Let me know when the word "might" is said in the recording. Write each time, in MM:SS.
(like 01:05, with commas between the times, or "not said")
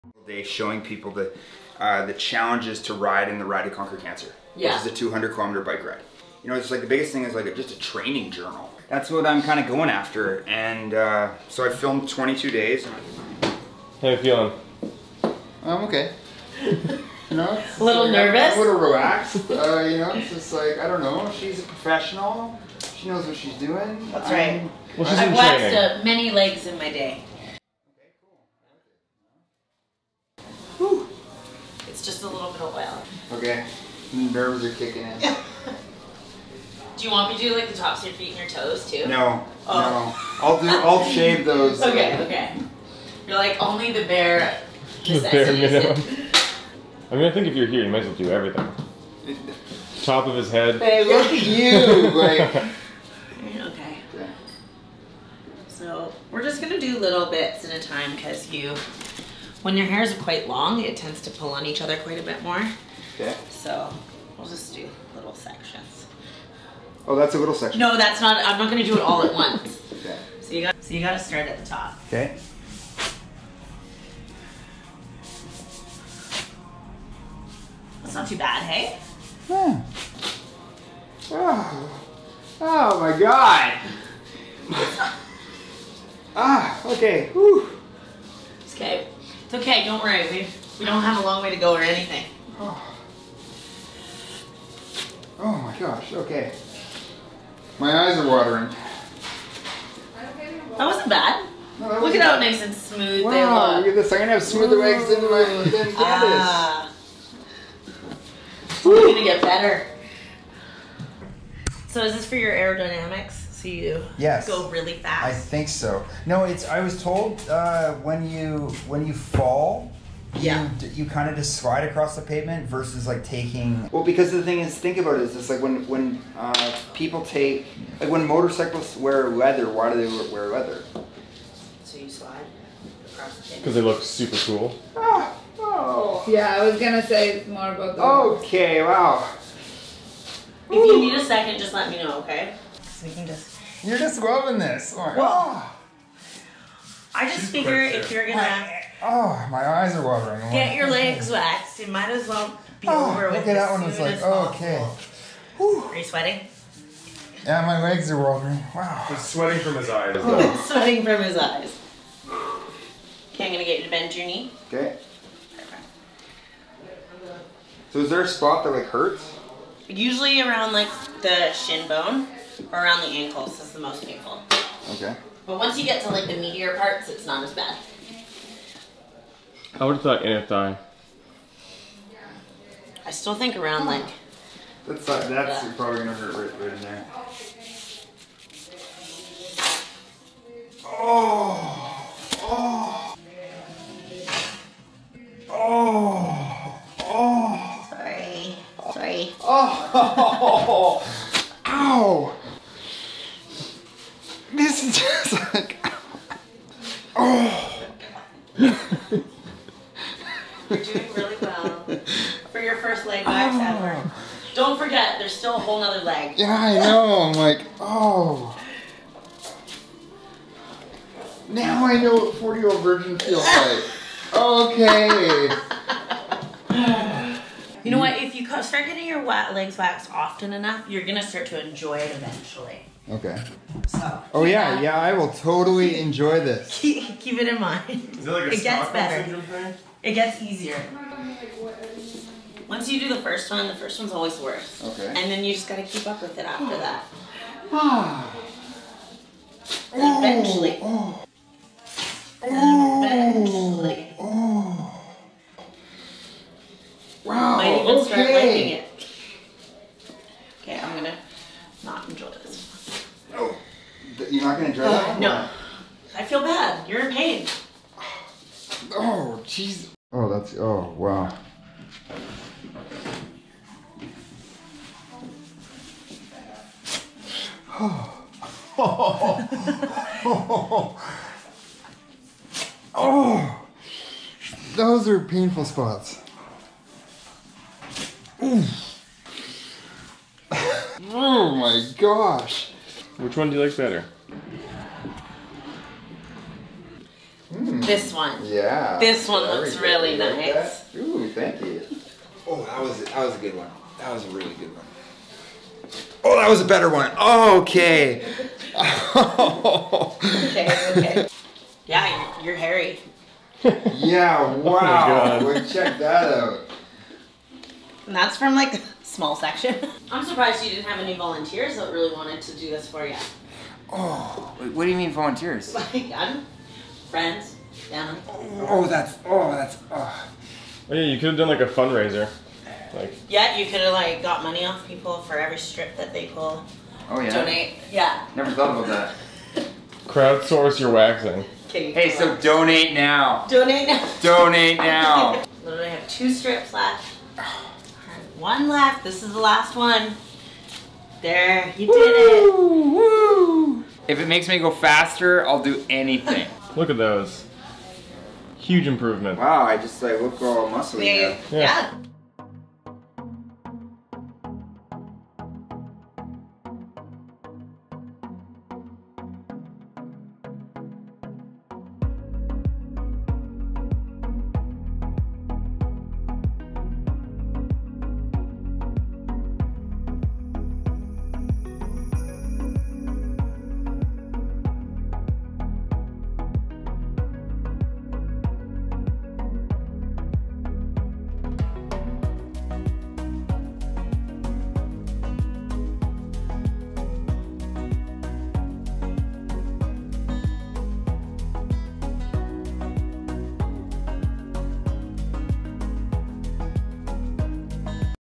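00:47, 02:31, 04:17.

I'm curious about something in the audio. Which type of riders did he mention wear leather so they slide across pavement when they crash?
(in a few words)
motorcyclists.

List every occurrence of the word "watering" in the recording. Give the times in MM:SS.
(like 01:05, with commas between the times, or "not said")
01:38, 02:30, 02:38.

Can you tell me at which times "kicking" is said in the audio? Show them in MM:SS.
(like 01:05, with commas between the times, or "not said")
00:34.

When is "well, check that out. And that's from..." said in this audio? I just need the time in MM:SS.
05:15.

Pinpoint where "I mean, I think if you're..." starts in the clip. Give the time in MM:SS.
00:47.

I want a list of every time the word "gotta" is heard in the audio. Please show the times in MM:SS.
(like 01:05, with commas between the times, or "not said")
01:11, 04:05.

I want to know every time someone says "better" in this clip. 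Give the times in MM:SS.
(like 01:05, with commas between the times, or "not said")
01:49, 03:58, 04:53, 05:06.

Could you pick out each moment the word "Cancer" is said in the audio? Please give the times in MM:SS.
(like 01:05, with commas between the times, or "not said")
00:03.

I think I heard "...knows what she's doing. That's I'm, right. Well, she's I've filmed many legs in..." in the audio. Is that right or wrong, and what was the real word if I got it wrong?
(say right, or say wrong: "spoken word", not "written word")
wrong: "waxed", not "filmed".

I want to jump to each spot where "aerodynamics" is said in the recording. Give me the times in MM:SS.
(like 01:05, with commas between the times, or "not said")
01:52.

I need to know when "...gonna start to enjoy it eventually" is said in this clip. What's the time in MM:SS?
03:51.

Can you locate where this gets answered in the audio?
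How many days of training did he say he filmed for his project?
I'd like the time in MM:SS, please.
00:12.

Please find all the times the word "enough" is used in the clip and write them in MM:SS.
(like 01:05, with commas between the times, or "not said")
03:50.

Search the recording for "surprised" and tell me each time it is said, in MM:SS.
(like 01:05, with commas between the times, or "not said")
05:20.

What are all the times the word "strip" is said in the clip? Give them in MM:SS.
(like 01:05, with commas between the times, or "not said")
05:35, 05:46.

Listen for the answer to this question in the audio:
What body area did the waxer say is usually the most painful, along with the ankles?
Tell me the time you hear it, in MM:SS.
02:51.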